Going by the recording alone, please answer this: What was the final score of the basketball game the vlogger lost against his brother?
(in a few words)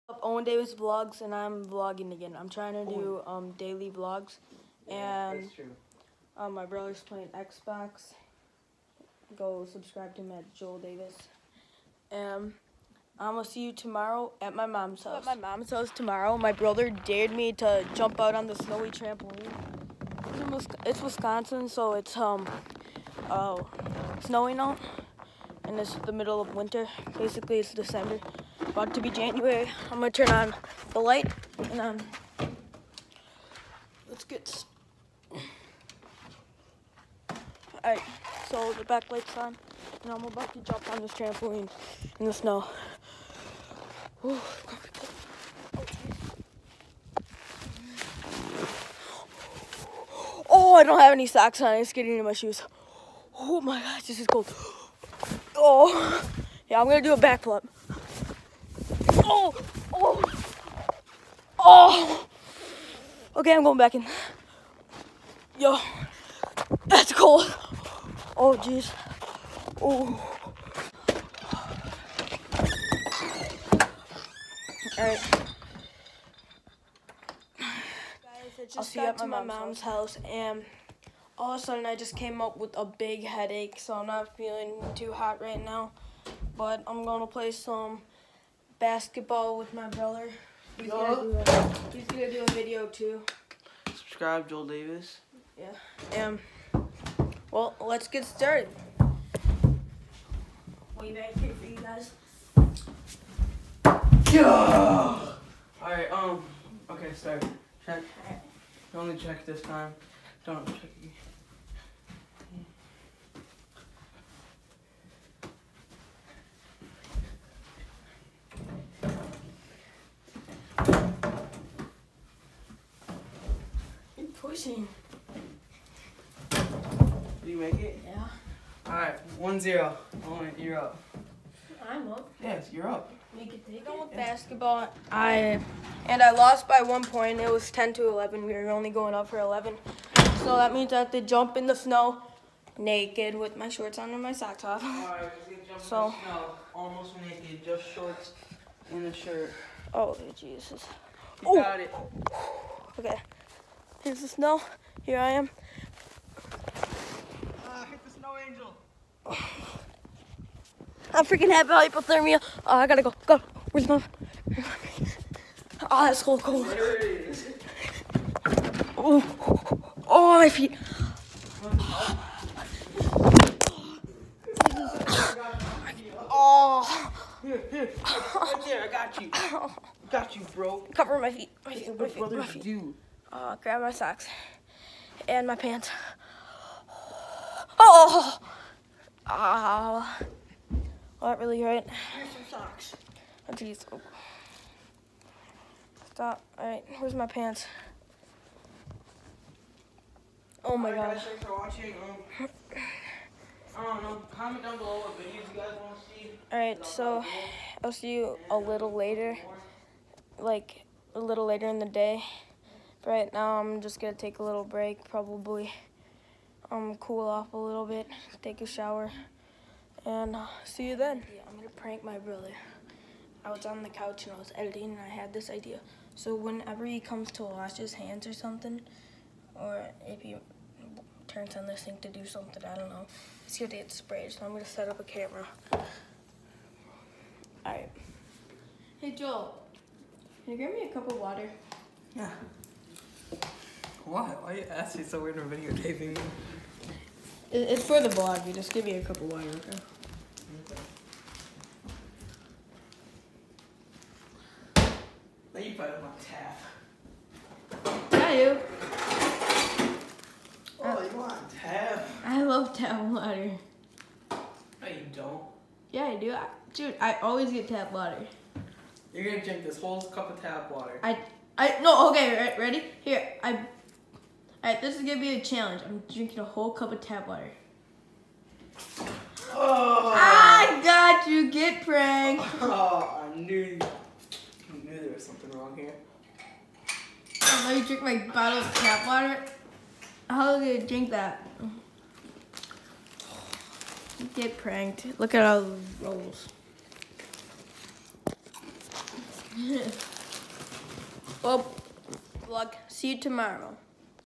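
10 to 11.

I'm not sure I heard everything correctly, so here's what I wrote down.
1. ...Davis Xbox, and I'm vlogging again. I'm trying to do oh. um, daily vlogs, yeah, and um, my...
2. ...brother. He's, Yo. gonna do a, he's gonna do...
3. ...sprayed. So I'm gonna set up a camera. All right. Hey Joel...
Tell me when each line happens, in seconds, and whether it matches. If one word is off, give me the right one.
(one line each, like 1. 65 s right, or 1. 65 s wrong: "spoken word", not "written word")
1. 0 s wrong: "Vlogs", not "Xbox"
2. 89 s right
3. 233 s right.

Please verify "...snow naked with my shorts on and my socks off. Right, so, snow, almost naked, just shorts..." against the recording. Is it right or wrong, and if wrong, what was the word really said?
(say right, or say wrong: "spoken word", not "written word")
right.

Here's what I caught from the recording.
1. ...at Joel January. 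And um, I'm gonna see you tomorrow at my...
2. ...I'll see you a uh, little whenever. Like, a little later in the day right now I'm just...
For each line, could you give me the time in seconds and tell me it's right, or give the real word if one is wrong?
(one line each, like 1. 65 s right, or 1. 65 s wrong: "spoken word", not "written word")
1. 10 s wrong: "Davis", not "January"
2. 207 s wrong: "later", not "whenever".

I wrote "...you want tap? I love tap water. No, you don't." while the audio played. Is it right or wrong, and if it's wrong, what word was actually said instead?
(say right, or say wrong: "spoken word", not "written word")
right.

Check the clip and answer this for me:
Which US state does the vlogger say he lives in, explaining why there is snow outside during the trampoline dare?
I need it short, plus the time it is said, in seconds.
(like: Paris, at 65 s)
Wisconsin, at 21 s.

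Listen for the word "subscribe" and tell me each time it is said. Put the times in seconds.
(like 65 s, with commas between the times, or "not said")
9 s, 93 s.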